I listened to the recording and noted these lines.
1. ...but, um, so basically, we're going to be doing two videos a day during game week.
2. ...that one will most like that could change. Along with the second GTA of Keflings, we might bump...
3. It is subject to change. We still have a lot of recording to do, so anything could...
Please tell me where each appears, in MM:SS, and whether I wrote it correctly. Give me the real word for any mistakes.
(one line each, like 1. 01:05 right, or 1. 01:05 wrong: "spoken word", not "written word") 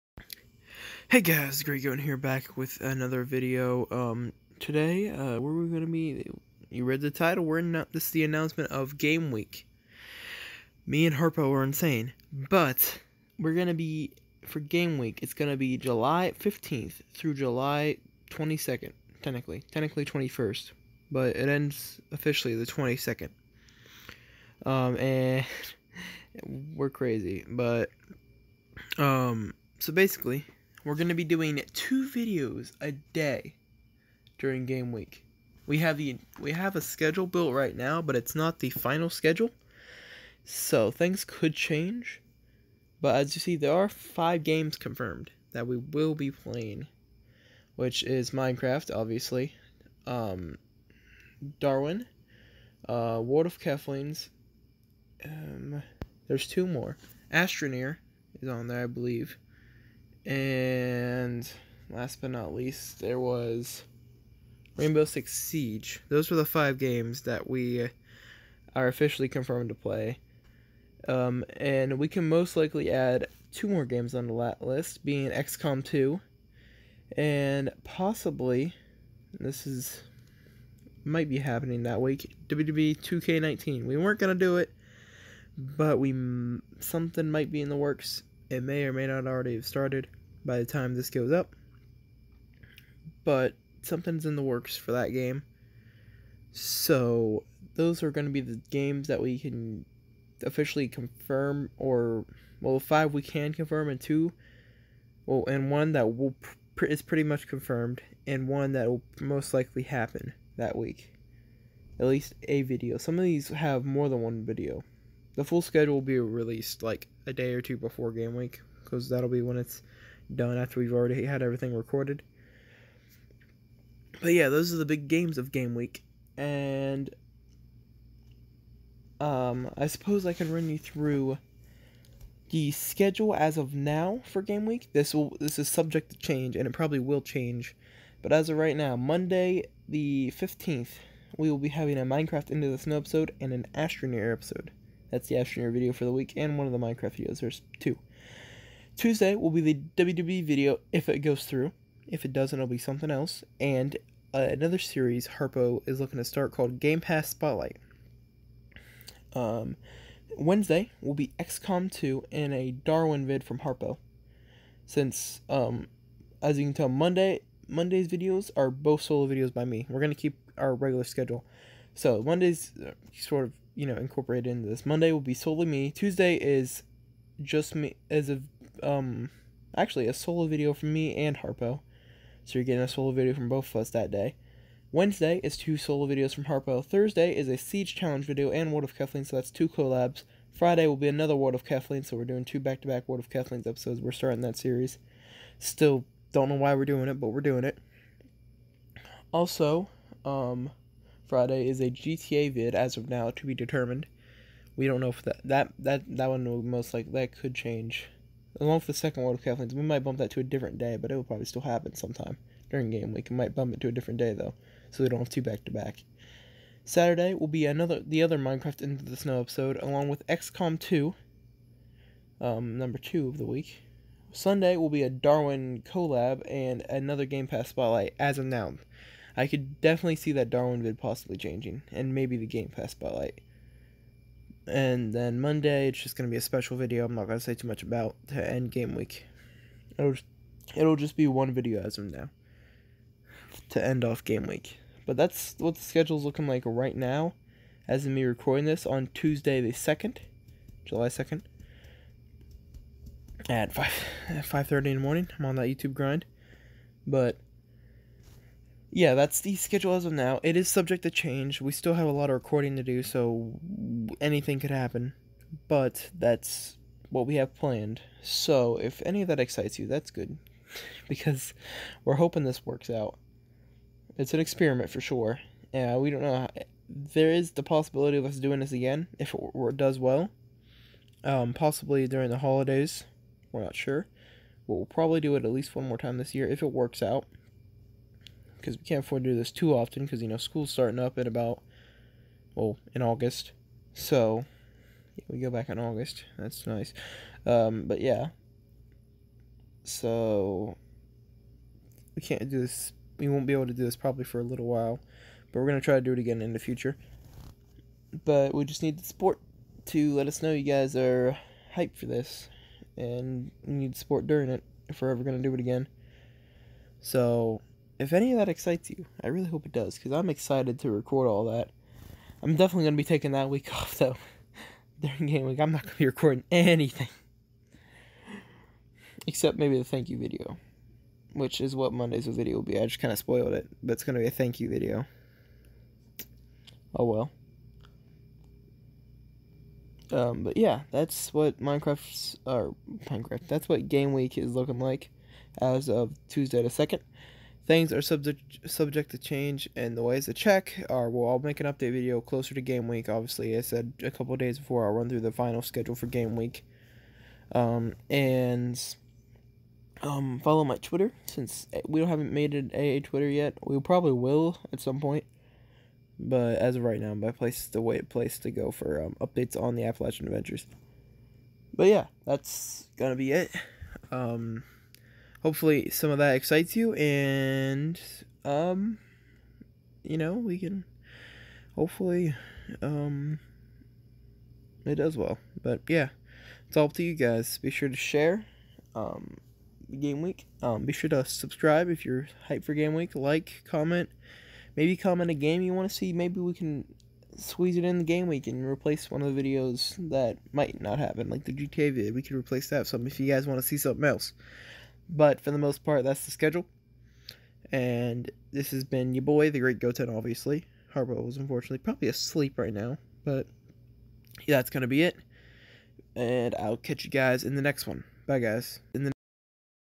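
1. 00:27 right
2. 03:26 wrong: "World", not "GTA"
3. 04:20 right.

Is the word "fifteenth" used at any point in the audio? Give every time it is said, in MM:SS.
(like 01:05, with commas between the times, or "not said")
02:20.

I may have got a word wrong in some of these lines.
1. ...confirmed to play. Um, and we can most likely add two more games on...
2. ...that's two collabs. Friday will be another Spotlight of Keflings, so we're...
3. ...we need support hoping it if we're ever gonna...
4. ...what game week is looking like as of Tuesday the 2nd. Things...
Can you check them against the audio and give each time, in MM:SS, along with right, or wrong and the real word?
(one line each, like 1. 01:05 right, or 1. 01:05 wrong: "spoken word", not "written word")
1. 01:09 right
2. 03:09 wrong: "World", not "Spotlight"
3. 05:13 wrong: "during", not "hoping"
4. 05:43 right.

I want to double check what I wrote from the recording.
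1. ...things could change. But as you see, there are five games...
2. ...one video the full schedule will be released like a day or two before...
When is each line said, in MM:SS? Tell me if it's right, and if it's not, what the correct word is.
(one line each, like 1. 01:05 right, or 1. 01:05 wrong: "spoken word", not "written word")
1. 00:40 right
2. 01:54 right.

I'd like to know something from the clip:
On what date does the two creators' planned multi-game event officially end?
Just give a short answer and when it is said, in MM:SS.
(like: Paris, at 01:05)
July 22nd, at 00:21.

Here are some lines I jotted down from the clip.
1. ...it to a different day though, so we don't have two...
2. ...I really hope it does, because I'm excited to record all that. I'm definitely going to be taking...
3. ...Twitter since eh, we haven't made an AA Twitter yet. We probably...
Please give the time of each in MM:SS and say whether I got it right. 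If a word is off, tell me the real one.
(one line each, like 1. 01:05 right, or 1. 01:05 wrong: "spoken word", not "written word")
1. 03:33 right
2. 05:19 right
3. 06:00 right.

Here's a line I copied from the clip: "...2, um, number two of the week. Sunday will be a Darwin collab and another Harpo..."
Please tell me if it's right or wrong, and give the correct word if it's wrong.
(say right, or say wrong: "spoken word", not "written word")
wrong: "Game", not "Harpo".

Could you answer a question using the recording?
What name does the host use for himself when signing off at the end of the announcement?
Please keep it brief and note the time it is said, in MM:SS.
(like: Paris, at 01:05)
the Great Goten, at 06:49.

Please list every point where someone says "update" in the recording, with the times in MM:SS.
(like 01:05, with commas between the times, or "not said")
05:51, 06:09.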